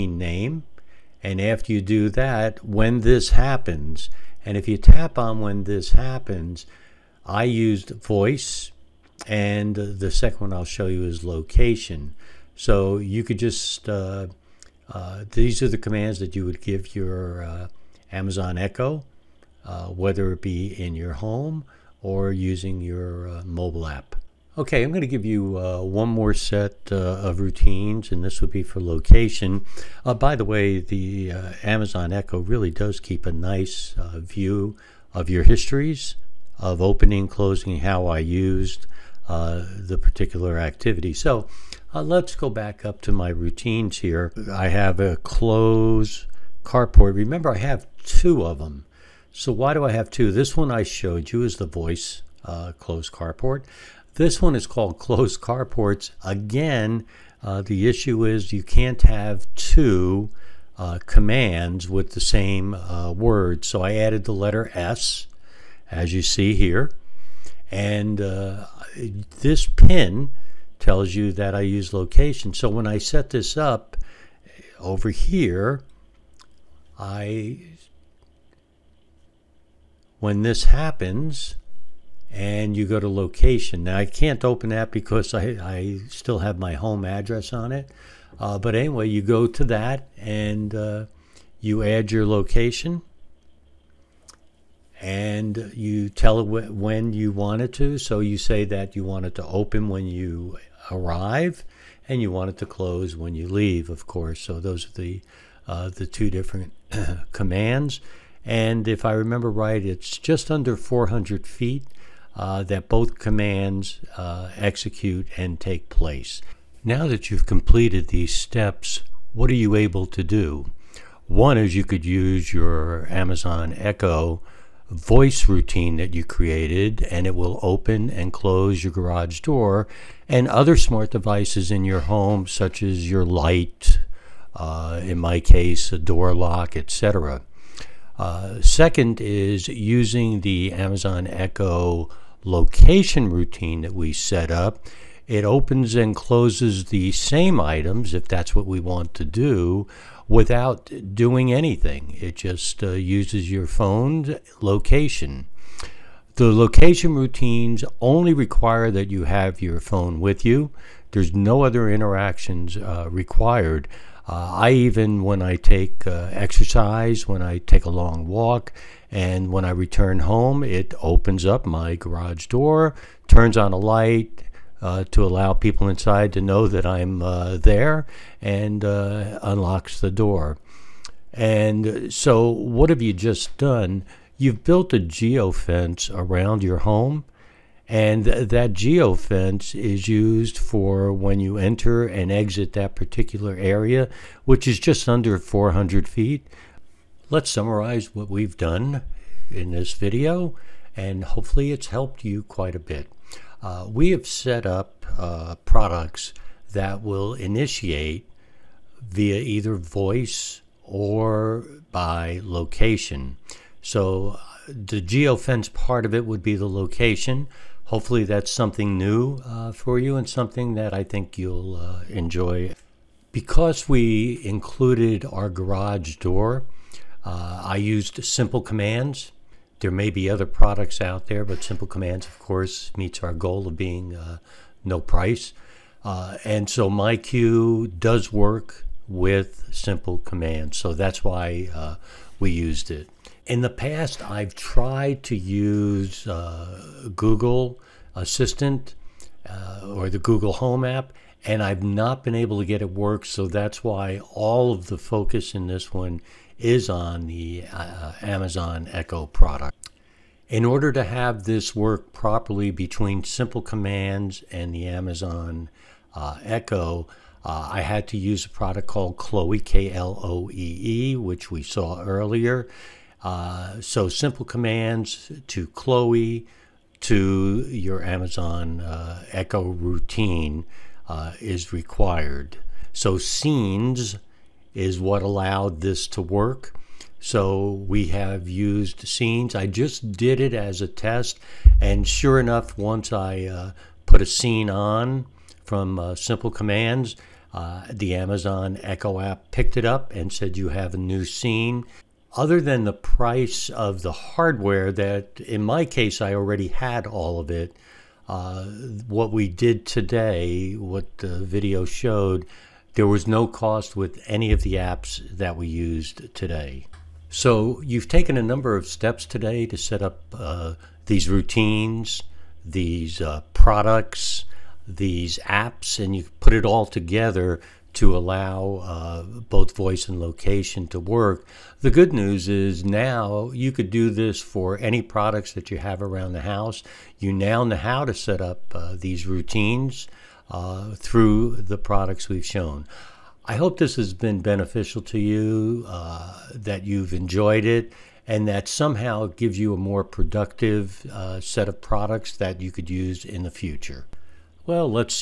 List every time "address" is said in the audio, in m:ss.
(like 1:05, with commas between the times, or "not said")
1:27.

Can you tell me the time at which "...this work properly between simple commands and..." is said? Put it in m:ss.
4:21.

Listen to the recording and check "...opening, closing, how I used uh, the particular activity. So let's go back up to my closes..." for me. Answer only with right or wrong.
wrong.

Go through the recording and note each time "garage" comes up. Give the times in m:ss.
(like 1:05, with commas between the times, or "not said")
2:08, 2:51, 3:45.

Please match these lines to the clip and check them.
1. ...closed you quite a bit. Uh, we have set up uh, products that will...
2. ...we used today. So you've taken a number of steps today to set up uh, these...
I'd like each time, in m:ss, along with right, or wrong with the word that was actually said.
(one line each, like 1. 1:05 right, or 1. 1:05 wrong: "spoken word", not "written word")
1. 3:21 wrong: "helped", not "closed"
2. 5:15 right.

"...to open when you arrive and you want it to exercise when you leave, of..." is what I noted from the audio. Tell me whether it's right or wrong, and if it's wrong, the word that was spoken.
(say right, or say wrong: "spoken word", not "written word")
wrong: "close", not "exercise".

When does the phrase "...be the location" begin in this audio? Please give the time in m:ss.
3:36.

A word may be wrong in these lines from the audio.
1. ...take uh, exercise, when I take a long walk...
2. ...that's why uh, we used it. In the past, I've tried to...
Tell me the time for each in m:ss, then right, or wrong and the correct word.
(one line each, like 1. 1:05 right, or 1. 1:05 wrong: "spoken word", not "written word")
1. 2:45 right
2. 4:00 right.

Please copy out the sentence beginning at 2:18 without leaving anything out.
Uh, second is using the Amazon Echo location routine that we set up.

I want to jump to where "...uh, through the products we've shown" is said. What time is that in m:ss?
5:40.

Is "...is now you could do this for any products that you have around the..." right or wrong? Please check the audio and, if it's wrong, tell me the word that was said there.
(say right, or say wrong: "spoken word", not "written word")
right.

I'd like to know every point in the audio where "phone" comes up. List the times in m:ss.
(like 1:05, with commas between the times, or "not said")
2:33, 2:39.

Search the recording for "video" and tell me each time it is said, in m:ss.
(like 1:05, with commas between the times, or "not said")
3:19, 5:11.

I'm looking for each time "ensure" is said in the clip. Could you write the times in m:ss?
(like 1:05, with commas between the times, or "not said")
not said.